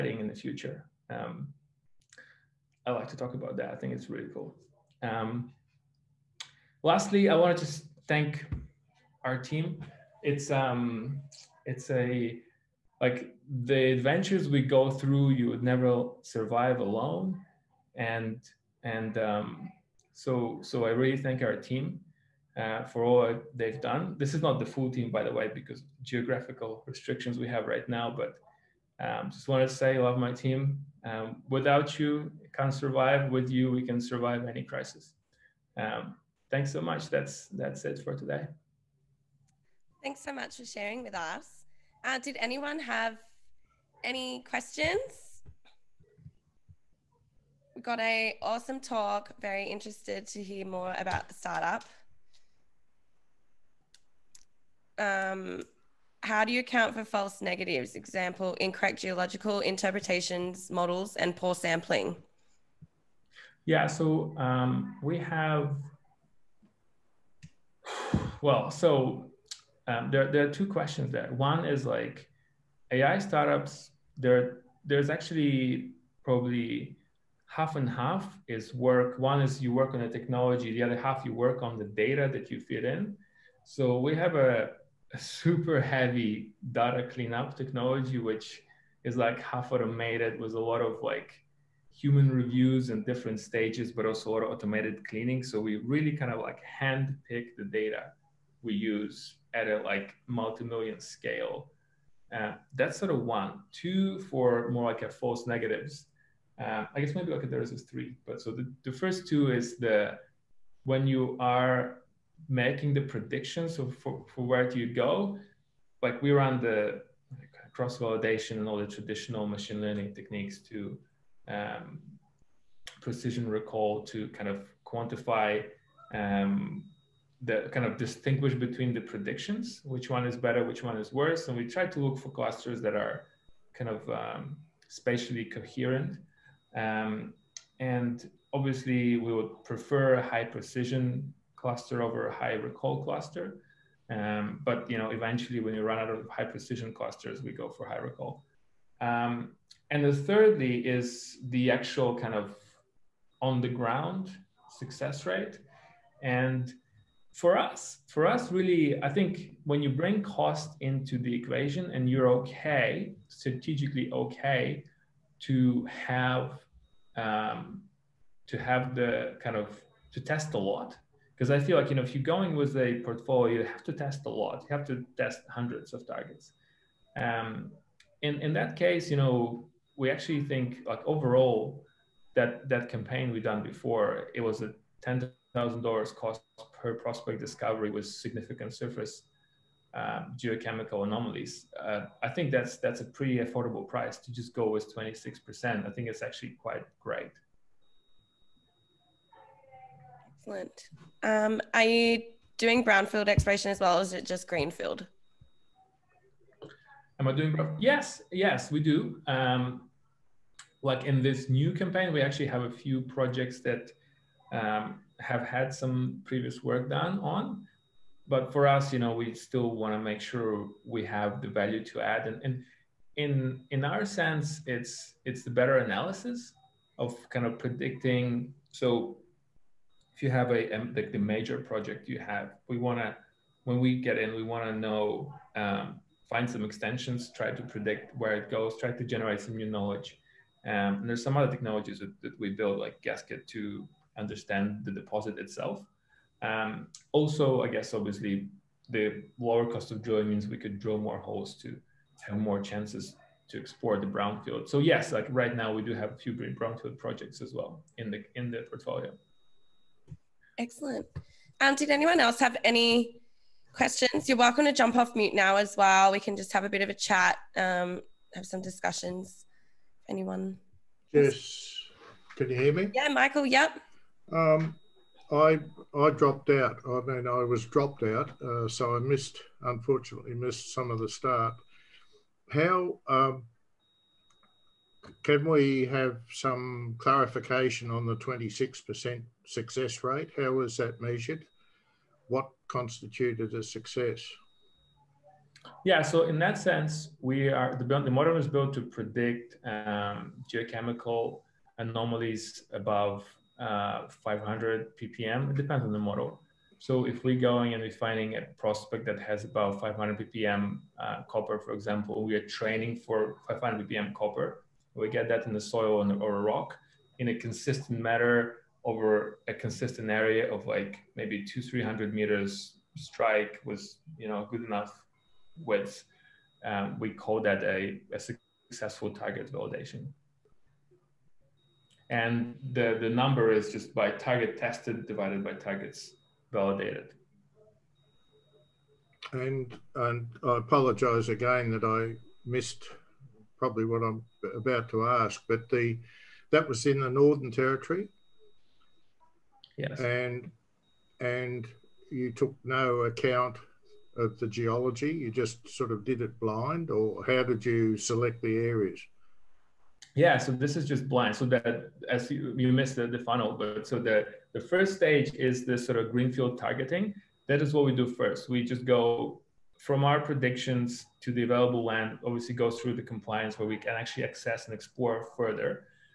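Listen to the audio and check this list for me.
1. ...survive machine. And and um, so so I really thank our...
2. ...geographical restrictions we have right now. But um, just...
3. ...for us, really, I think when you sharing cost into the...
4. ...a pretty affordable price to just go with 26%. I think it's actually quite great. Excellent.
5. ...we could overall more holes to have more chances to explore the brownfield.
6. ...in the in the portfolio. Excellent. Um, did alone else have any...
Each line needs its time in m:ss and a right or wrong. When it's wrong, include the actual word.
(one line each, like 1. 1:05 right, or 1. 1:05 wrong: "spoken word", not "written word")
1. 0:16 wrong: "alone", not "machine"
2. 0:26 right
3. 2:38 wrong: "bring", not "sharing"
4. 3:12 right
5. 4:10 wrong: "drill", not "overall"
6. 4:17 wrong: "anyone", not "alone".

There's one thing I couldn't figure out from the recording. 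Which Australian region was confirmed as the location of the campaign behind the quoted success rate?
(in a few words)
Northern Territory.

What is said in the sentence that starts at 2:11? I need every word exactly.
And we try to look for clusters that are kind of um, spatially coherent.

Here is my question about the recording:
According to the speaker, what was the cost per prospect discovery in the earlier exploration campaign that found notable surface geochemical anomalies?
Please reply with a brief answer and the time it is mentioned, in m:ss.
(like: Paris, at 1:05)
$10,000, at 3:05.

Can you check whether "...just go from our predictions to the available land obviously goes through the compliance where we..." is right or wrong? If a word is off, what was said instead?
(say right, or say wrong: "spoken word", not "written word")
right.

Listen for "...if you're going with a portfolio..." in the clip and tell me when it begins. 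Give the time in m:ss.
2:52.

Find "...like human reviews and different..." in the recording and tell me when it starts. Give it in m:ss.
1:31.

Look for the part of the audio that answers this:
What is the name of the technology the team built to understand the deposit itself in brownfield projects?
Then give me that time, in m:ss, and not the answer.
4:03.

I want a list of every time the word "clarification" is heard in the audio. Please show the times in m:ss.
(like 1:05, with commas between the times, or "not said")
4:46.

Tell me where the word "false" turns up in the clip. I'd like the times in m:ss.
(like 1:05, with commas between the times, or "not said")
0:57, 1:45.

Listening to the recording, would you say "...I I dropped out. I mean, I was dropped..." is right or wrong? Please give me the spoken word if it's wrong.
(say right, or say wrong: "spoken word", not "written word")
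right.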